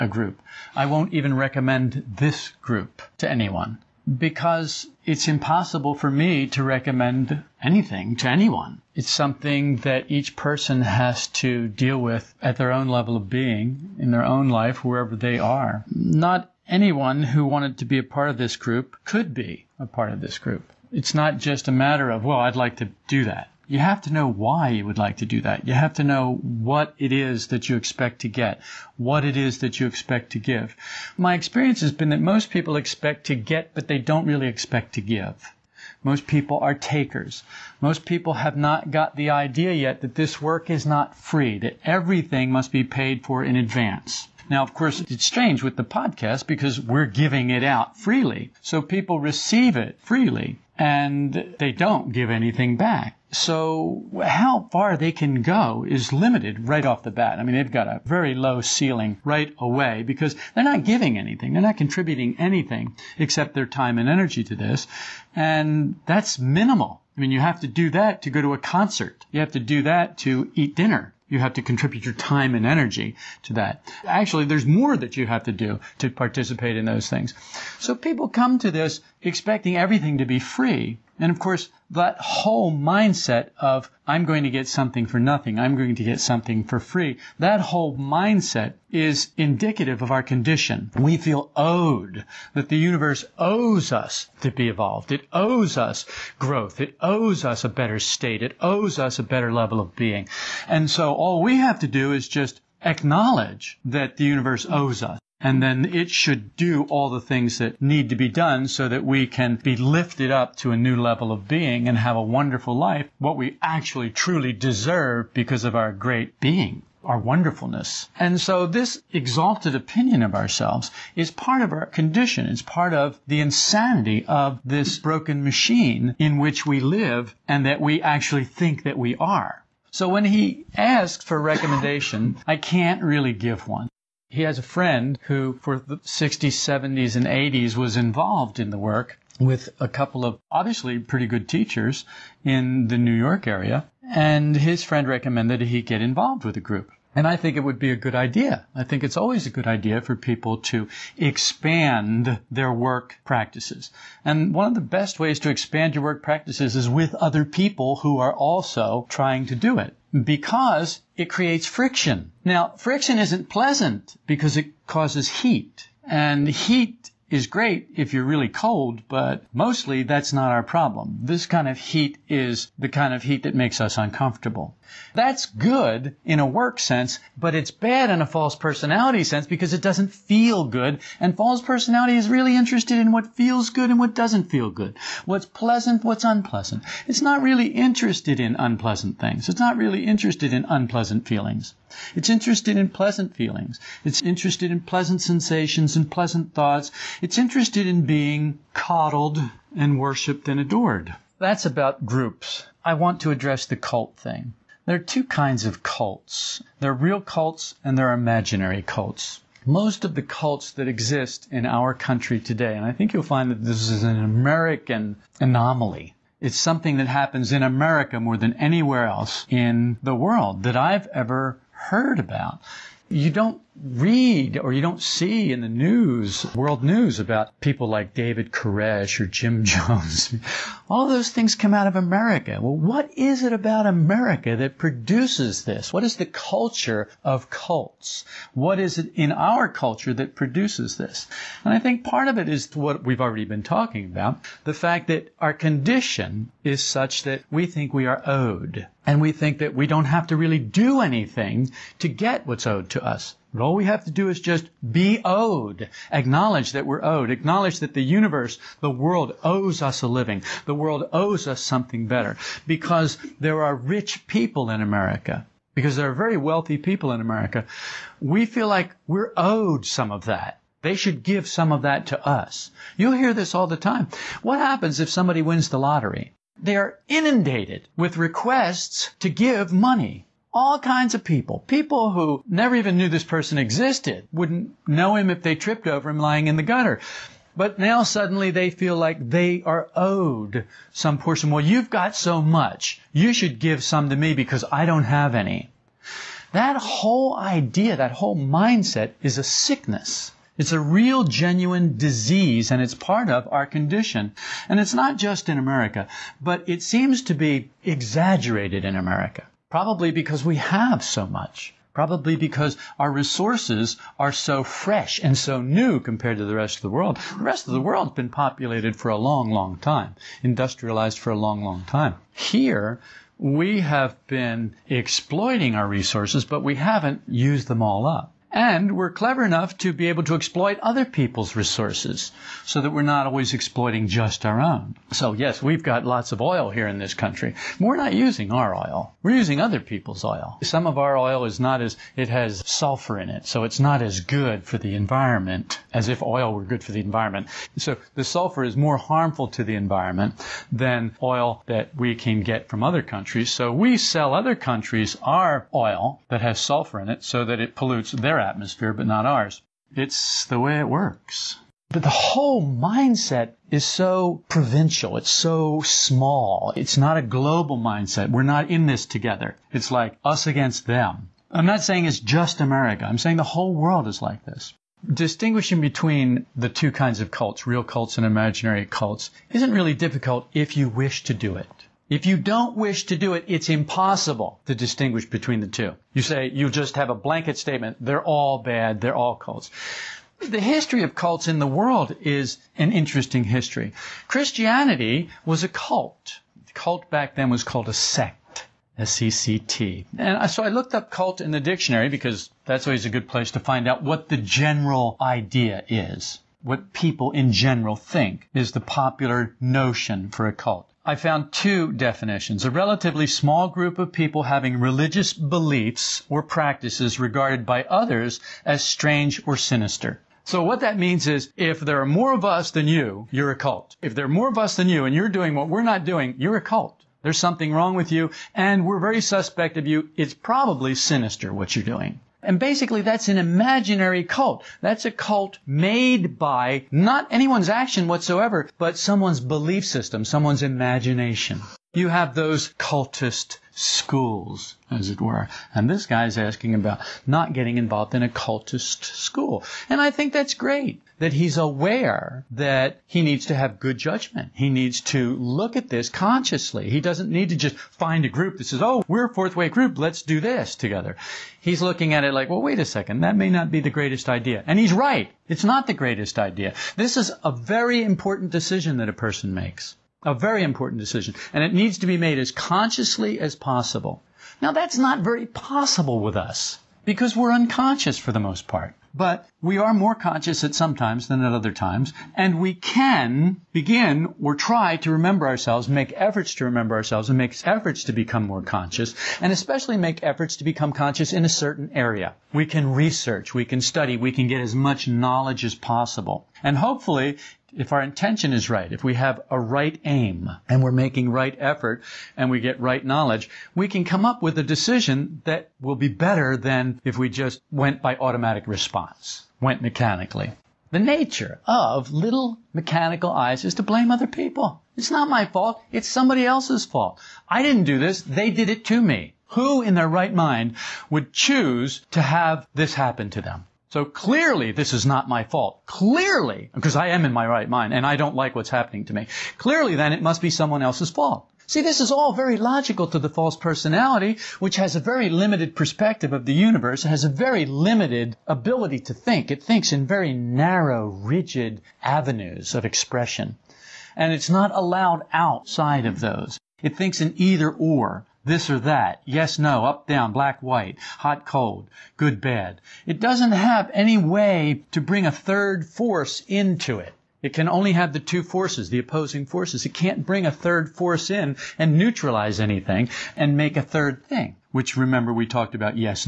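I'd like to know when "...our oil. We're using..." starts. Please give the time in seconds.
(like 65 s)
338 s.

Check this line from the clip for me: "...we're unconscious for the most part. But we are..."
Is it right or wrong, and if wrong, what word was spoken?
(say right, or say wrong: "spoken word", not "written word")
right.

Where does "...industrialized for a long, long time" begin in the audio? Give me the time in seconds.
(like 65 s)
320 s.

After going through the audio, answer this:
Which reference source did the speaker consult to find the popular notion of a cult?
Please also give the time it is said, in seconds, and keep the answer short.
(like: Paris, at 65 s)
the dictionary, at 401 s.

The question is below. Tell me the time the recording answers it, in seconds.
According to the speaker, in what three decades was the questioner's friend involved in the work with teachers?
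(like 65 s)
135 s.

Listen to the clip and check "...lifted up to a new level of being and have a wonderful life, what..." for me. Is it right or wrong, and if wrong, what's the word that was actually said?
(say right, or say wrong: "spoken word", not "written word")
right.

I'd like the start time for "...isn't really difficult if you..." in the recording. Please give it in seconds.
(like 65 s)
379 s.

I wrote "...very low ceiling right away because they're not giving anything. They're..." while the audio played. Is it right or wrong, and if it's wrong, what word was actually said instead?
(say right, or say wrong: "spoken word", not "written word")
right.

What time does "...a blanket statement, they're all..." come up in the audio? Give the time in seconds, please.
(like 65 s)
387 s.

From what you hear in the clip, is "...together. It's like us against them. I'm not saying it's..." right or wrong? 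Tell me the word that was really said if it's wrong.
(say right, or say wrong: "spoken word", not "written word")
right.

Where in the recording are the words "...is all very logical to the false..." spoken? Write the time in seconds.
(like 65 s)
532 s.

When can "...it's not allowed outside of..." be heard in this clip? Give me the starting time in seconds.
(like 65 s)
544 s.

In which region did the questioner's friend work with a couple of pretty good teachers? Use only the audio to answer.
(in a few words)
New York area.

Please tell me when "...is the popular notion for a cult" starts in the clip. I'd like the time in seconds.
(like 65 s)
408 s.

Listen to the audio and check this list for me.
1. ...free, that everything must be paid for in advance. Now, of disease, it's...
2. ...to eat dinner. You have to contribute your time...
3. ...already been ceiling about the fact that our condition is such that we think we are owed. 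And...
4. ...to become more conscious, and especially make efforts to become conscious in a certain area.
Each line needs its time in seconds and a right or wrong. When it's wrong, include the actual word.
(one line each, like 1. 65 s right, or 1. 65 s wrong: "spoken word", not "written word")
1. 41 s wrong: "course", not "disease"
2. 70 s right
3. 243 s wrong: "talking", not "ceiling"
4. 488 s right.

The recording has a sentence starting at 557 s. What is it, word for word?
It can only have the two forces, the opposing forces.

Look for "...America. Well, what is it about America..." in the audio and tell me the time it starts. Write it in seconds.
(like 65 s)
231 s.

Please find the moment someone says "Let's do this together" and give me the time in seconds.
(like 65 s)
459 s.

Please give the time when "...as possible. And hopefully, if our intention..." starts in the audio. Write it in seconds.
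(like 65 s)
495 s.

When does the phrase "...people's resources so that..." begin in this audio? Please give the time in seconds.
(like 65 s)
331 s.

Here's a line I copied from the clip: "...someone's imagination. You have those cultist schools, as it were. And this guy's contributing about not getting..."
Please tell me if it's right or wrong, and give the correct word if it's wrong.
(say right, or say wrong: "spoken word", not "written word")
wrong: "asking", not "contributing".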